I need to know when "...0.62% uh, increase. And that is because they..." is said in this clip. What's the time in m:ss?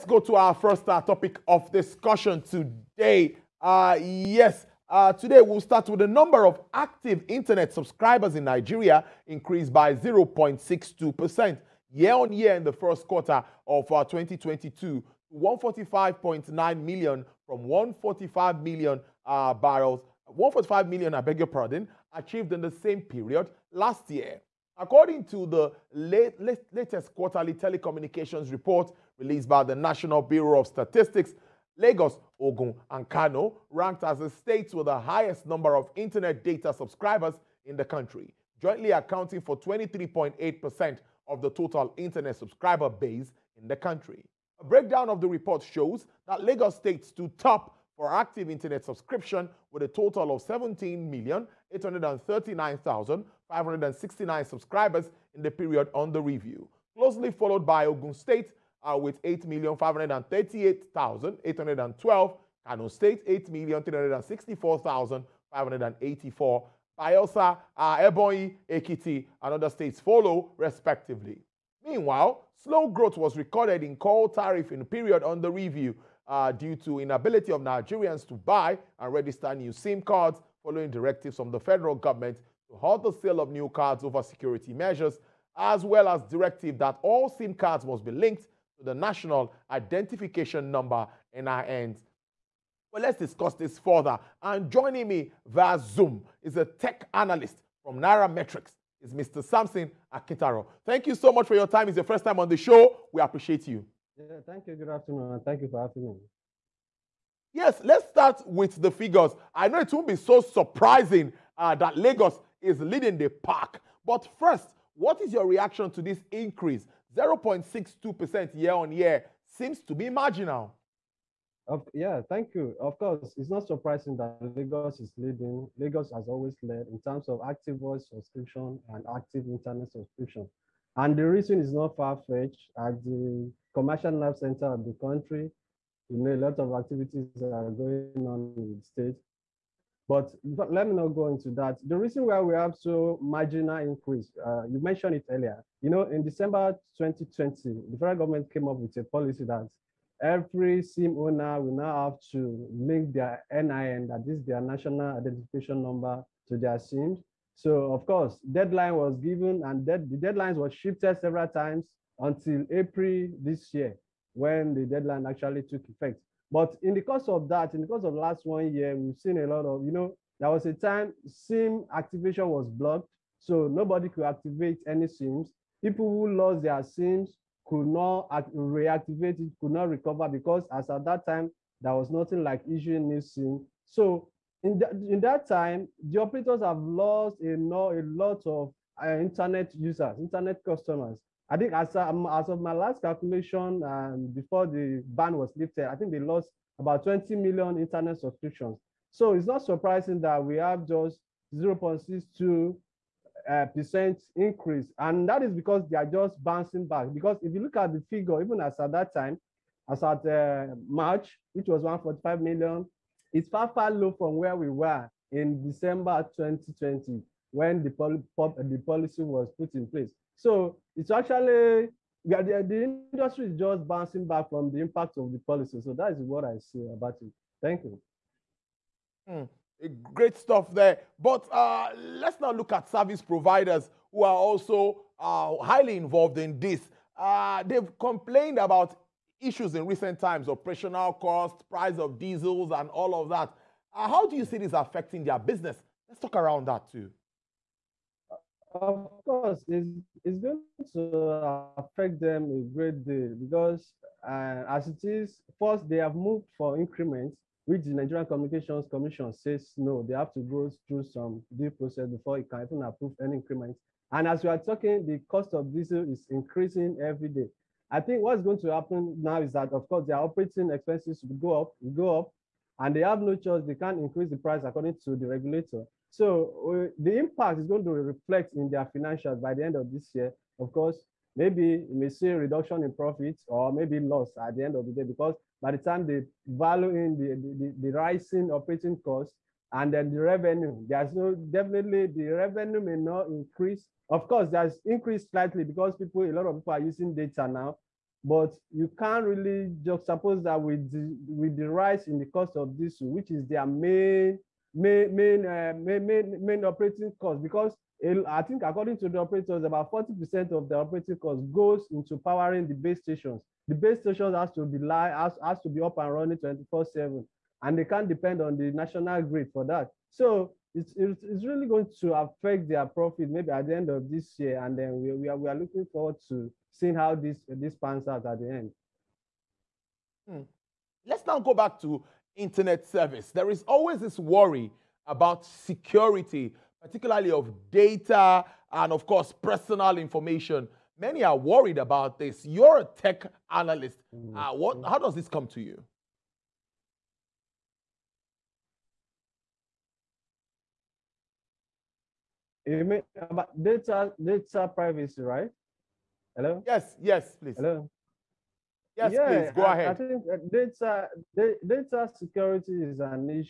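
3:21.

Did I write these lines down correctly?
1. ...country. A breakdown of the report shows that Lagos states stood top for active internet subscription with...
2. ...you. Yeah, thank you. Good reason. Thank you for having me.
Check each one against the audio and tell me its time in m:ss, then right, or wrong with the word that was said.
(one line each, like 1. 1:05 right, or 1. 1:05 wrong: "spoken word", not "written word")
1. 0:43 right
2. 1:43 wrong: "afternoon", not "reason".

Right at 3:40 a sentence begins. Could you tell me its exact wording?
So it's actually the, the, industry is just bouncing back from the impact of the policy.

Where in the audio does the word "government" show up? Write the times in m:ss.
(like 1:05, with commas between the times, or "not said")
1:21, 2:28.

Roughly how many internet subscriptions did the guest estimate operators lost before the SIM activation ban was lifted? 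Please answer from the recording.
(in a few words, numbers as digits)
20 million.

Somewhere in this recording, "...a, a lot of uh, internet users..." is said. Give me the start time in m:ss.
3:07.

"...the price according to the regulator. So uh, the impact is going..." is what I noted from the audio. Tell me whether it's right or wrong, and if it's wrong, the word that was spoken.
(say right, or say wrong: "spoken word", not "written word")
right.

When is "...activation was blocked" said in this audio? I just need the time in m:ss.
2:51.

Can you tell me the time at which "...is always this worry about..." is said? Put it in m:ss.
5:33.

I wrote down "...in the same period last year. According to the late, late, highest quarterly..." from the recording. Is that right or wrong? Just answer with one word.
wrong.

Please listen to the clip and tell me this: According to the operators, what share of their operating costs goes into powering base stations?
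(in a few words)
40%.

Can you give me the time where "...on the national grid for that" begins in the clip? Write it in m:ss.
5:18.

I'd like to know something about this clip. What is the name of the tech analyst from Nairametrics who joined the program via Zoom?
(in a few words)
Samson Akintaro.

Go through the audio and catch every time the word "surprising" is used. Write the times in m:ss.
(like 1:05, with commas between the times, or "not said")
1:50, 2:03, 3:19.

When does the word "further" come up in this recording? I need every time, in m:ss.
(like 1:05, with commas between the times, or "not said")
1:33.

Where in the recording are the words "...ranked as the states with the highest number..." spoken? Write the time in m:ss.
0:33.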